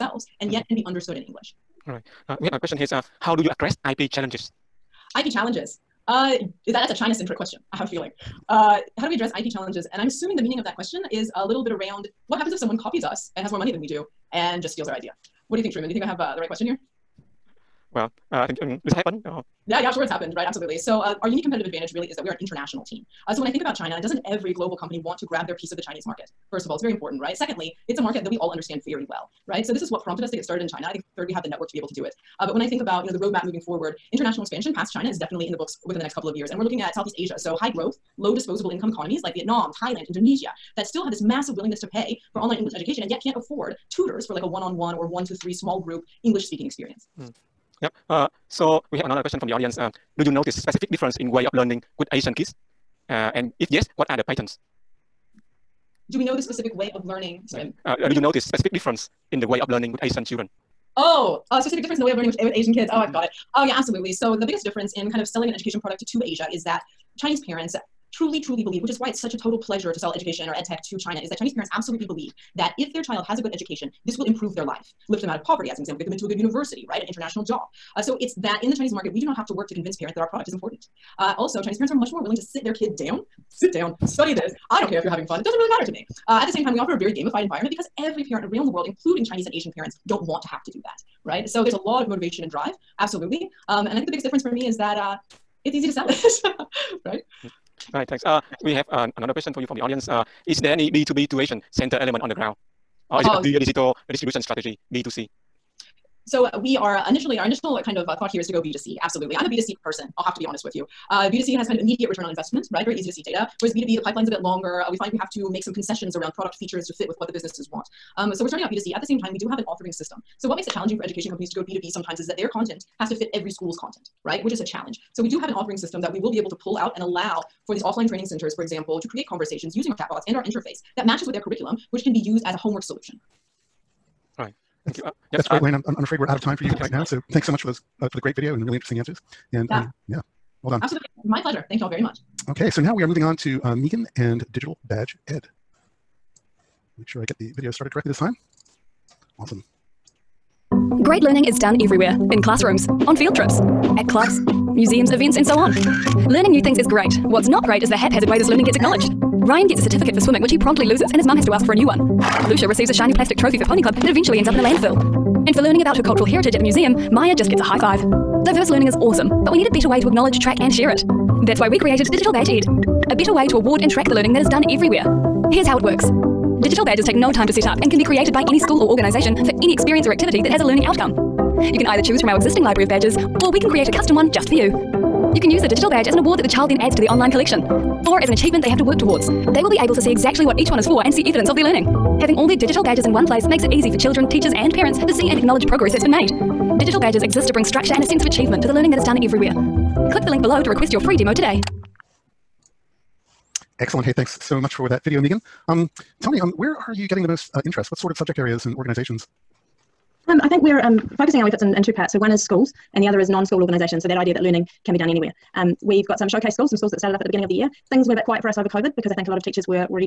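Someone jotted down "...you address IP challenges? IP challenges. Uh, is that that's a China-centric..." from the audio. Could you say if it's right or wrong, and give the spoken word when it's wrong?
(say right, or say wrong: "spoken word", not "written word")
right.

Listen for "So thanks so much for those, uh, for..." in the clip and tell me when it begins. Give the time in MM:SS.
02:17.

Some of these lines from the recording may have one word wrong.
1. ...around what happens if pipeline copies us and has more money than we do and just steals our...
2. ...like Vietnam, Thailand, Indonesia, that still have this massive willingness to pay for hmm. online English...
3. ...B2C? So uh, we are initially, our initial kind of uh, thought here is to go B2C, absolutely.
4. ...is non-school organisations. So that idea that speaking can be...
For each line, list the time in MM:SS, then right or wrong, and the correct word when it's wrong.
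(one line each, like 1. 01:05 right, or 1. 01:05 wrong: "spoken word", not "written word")
1. 00:11 wrong: "someone", not "pipeline"
2. 00:39 right
3. 01:44 right
4. 03:33 wrong: "learning", not "speaking".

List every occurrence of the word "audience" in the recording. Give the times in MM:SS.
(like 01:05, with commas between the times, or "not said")
00:49, 01:39.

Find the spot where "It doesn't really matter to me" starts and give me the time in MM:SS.
01:25.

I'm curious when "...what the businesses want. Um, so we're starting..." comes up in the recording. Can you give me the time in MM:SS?
01:57.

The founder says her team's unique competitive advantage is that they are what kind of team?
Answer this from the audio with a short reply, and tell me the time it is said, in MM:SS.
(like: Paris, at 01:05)
An international team, at 00:22.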